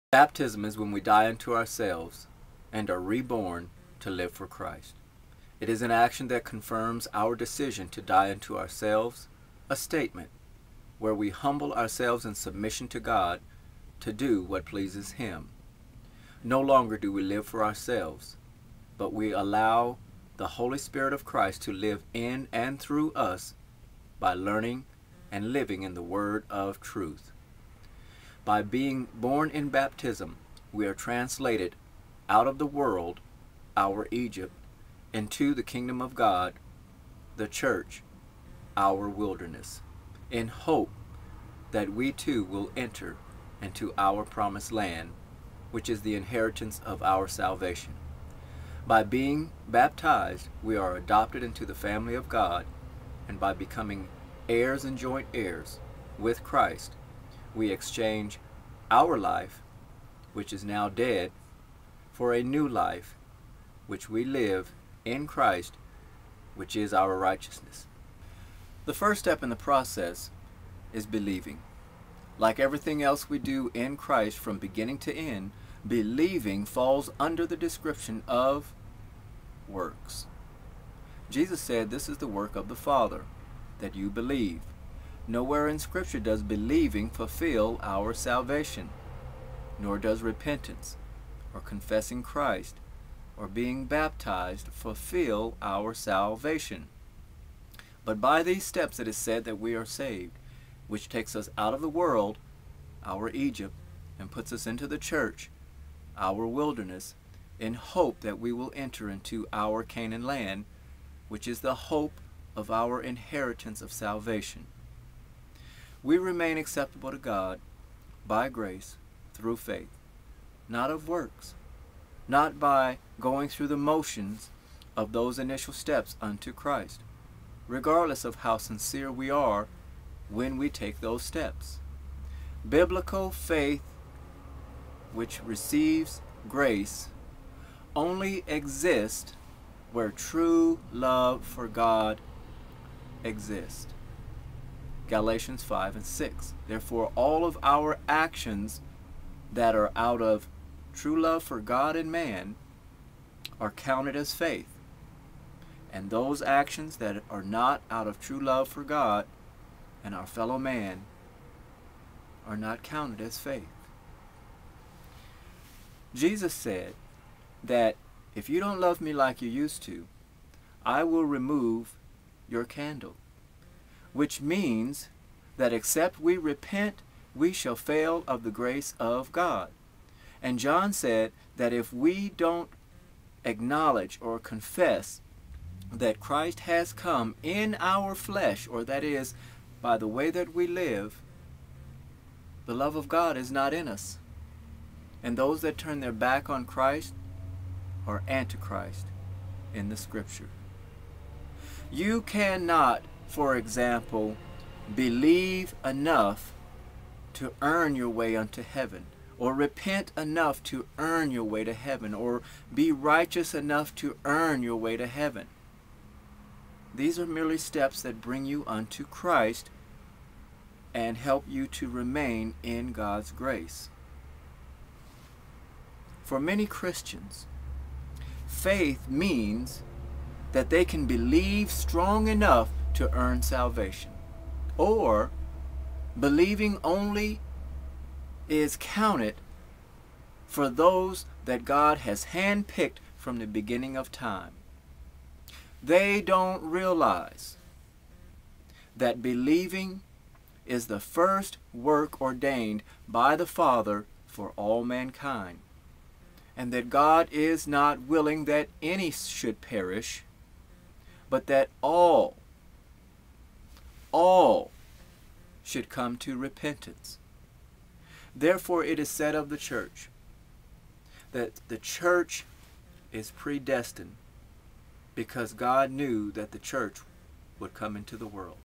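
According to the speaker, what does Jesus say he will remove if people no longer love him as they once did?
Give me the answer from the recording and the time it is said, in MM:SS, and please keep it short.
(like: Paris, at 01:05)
Candle, at 02:52.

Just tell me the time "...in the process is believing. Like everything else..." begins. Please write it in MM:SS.
01:09.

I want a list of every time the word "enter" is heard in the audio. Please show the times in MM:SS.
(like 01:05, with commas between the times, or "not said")
00:42, 01:48.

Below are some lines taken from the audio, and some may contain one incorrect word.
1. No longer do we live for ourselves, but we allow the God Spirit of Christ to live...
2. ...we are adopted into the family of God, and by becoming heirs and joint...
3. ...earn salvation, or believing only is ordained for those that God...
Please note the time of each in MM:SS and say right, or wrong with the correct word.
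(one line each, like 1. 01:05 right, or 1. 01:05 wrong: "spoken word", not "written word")
1. 00:16 wrong: "Holy", not "God"
2. 00:50 right
3. 03:53 wrong: "counted", not "ordained".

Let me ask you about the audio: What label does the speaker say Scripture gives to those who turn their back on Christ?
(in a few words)
Antichrist.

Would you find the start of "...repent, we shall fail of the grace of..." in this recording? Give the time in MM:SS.
02:56.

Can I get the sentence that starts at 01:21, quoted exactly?
Jesus said this is the work of the Father, that you believe.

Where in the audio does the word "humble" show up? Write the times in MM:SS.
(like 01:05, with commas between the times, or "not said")
00:11.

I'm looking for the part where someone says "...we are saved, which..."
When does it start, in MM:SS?
01:39.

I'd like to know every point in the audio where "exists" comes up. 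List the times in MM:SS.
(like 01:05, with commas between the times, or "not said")
02:18, 02:23.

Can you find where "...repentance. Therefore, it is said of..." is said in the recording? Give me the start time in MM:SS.
04:26.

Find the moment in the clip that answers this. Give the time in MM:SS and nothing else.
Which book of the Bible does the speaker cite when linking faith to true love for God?
02:25.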